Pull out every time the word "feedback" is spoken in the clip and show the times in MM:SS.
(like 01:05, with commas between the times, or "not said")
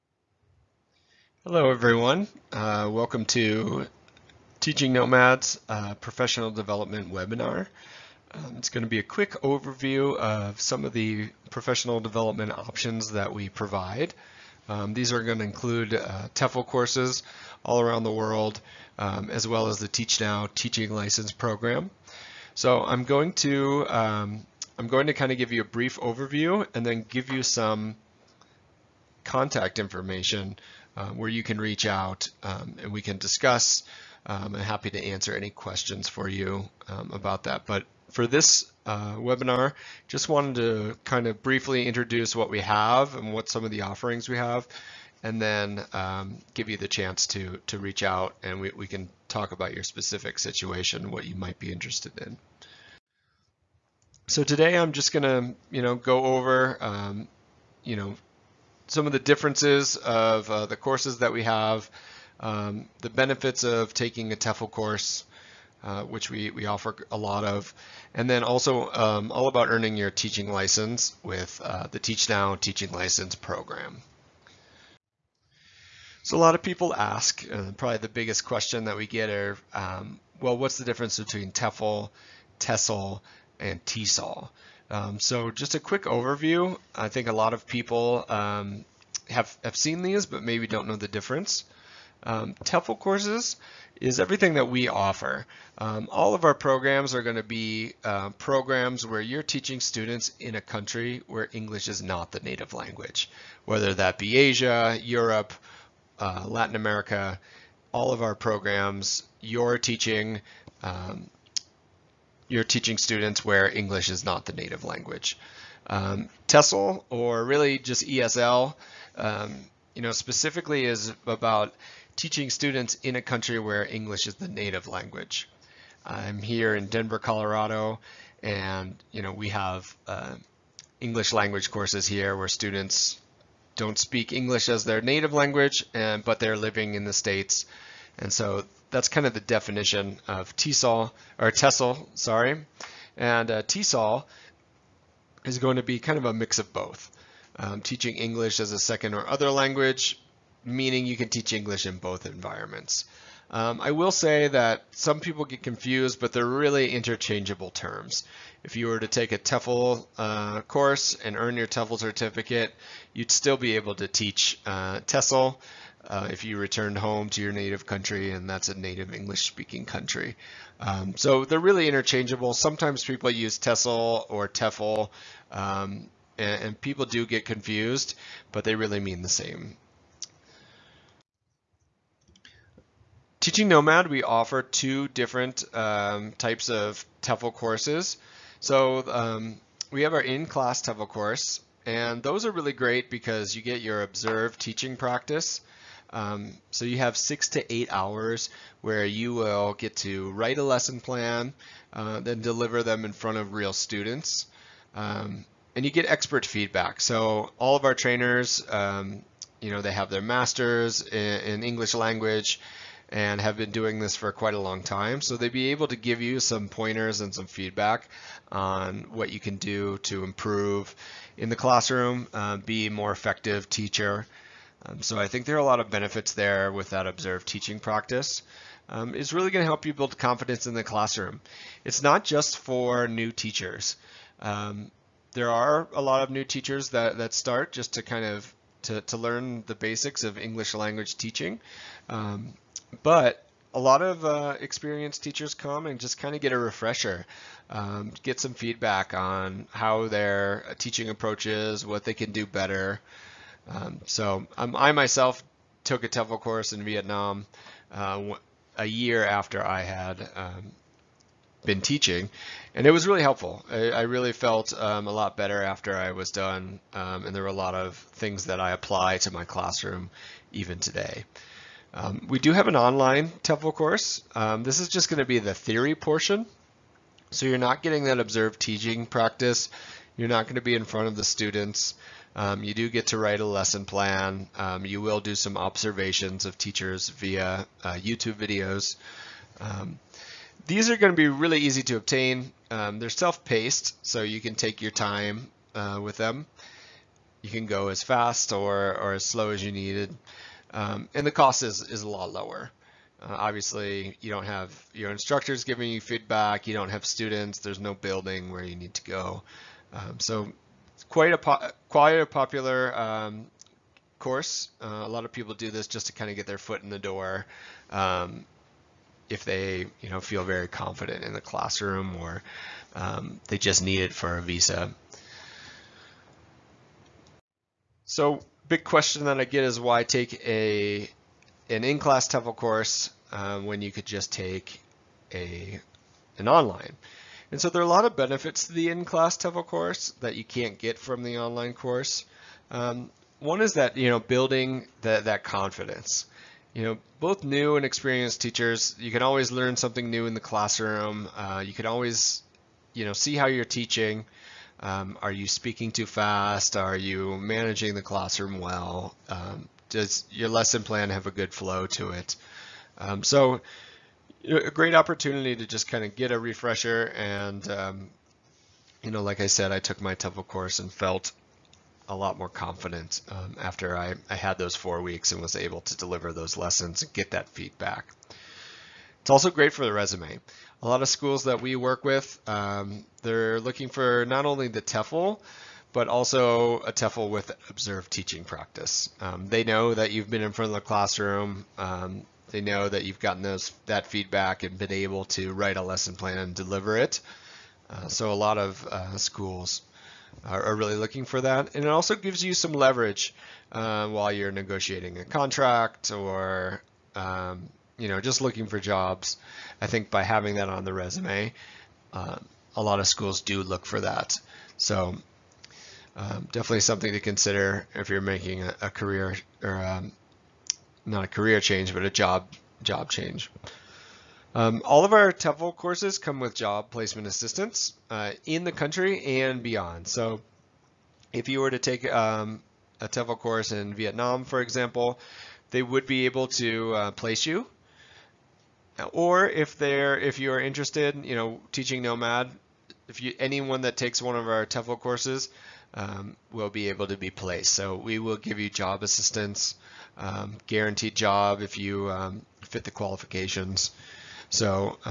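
03:26, 03:37, 04:08, 05:05, 06:17, 06:34.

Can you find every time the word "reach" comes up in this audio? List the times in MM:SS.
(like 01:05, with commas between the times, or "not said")
00:31, 00:47.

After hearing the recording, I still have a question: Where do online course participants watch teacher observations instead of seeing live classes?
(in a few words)
YouTube.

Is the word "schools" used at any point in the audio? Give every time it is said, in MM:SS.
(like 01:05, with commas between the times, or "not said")
06:21, 06:39, 06:53.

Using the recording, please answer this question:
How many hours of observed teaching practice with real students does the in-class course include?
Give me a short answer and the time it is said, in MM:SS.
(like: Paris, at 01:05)
6 to 8 hours, at 03:17.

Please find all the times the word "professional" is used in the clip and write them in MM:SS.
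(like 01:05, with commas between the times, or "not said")
00:05, 00:11.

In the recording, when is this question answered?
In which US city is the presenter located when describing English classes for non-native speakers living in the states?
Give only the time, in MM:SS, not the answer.
02:06.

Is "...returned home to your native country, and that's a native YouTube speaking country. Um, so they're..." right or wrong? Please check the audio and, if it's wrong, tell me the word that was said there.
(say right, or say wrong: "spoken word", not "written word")
wrong: "English", not "YouTube".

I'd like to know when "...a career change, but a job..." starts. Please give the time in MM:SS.
07:01.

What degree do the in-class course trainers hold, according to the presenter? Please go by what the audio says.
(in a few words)
Masters.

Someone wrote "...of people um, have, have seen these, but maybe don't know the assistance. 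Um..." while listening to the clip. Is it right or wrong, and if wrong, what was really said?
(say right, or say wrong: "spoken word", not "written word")
wrong: "difference", not "assistance".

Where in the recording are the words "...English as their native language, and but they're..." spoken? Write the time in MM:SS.
02:14.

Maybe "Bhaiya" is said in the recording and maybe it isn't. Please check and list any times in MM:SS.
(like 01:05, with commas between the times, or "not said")
not said.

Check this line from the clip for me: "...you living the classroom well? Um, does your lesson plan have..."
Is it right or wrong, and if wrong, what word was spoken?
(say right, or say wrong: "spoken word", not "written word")
wrong: "managing", not "living".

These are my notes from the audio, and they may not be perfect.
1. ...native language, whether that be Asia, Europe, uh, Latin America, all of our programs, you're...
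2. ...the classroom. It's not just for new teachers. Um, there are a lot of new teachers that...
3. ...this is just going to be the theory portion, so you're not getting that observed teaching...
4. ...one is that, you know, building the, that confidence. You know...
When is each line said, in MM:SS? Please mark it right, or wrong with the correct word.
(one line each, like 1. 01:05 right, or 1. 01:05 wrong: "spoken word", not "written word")
1. 01:42 right
2. 03:50 right
3. 04:34 right
4. 05:43 right.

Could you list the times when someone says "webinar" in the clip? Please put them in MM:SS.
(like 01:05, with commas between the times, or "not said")
00:07, 00:39.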